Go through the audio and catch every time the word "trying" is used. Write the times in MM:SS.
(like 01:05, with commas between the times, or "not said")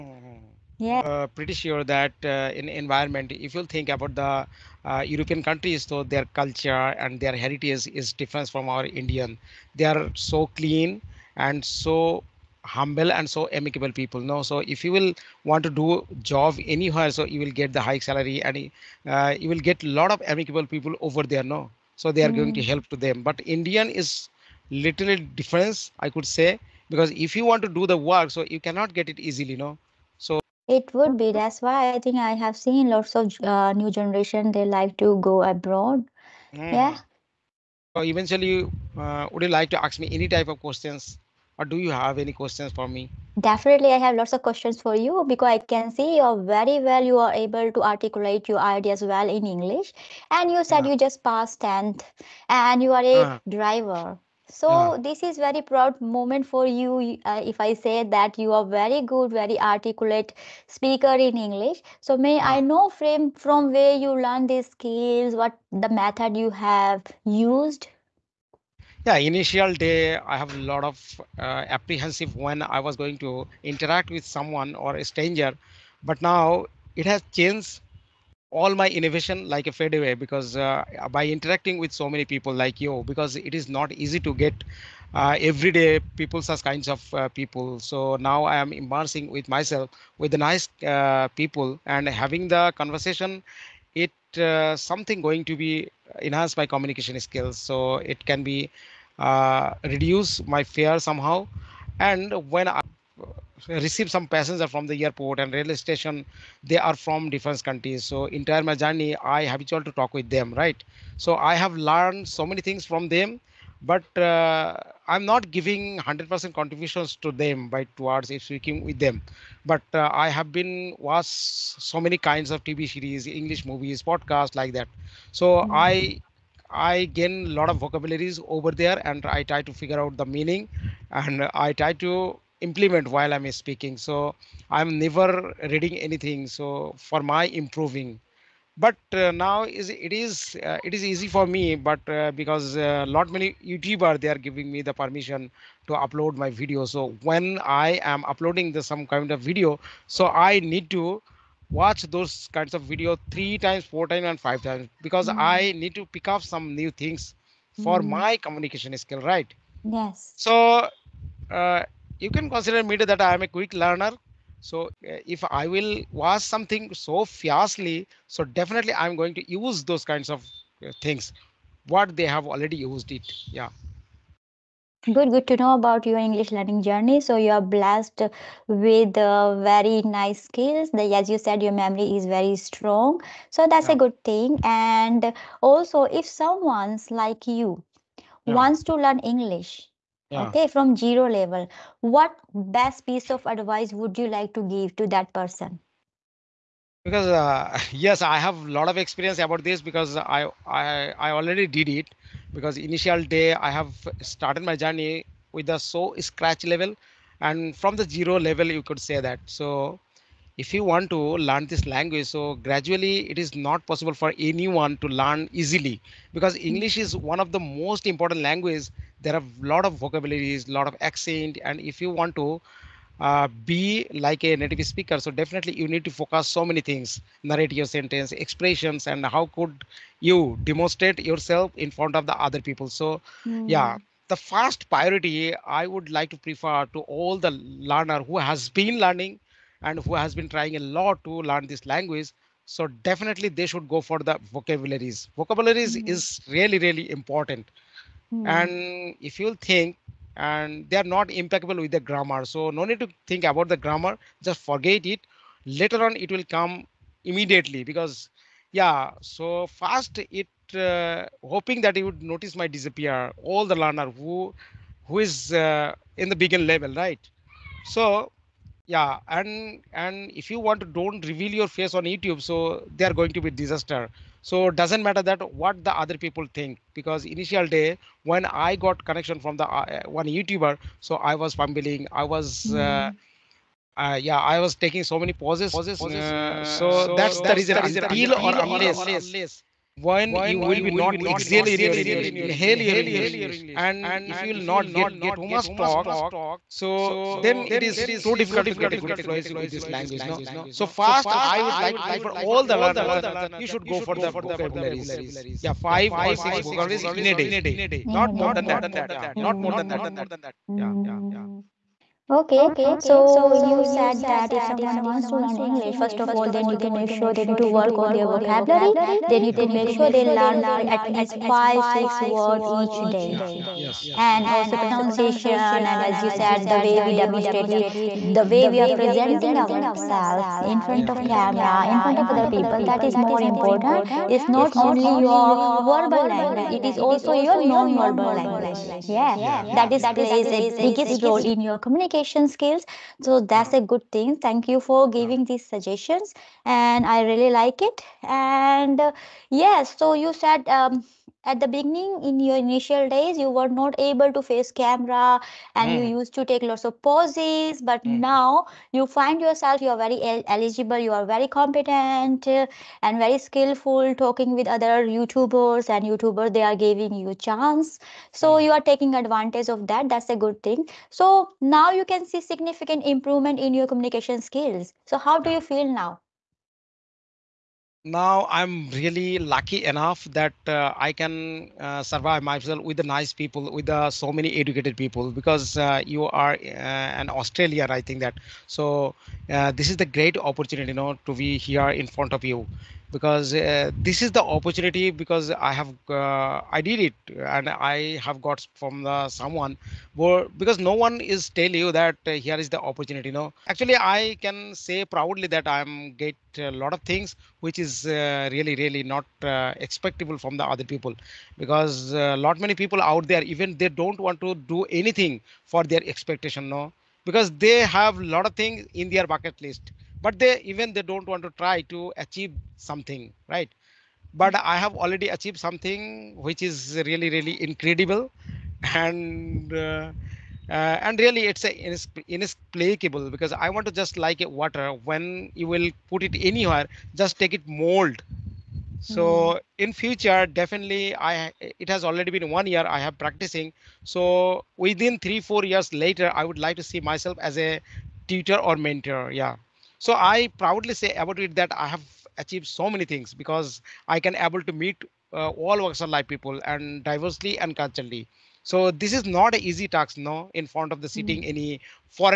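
04:00.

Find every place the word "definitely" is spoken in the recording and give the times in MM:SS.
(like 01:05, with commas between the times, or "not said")
00:43, 02:48, 03:45, 04:03, 07:20.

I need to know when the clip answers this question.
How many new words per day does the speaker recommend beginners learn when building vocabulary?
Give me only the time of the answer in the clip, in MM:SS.
05:05.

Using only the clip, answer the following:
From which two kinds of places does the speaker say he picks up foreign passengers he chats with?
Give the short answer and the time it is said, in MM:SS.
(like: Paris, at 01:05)
Airport and railway station, at 01:45.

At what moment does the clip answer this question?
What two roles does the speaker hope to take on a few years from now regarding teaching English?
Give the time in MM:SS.
07:28.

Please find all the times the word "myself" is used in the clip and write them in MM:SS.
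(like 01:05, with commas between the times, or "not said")
01:29, 06:22, 07:27.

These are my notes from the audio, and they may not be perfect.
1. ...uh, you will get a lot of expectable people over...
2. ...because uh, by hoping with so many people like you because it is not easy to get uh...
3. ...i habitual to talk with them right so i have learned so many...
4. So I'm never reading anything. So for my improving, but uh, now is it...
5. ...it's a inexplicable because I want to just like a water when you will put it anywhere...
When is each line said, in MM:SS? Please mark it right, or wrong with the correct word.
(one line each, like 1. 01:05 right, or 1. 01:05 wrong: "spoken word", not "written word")
1. 00:19 wrong: "amicable", not "expectable"
2. 01:20 wrong: "interacting", not "hoping"
3. 01:49 right
4. 02:13 right
5. 07:11 right.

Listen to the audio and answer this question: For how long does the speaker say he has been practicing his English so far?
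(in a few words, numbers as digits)
1 year.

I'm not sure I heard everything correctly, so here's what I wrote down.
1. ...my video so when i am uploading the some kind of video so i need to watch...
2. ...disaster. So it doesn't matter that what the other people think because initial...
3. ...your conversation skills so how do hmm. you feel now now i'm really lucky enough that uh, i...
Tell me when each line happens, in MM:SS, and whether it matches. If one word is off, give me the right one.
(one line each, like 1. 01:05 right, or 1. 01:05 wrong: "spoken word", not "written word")
1. 02:26 right
2. 04:33 right
3. 06:13 wrong: "communication", not "conversation".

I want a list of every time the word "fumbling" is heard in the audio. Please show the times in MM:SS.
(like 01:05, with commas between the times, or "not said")
04:41.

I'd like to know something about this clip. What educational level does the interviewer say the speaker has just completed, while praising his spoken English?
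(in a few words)
Tenth.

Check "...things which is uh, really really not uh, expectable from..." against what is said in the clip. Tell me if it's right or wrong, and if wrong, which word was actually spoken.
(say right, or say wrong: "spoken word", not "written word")
right.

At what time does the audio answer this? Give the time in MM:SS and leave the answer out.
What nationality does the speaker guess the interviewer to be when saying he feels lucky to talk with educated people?
06:27.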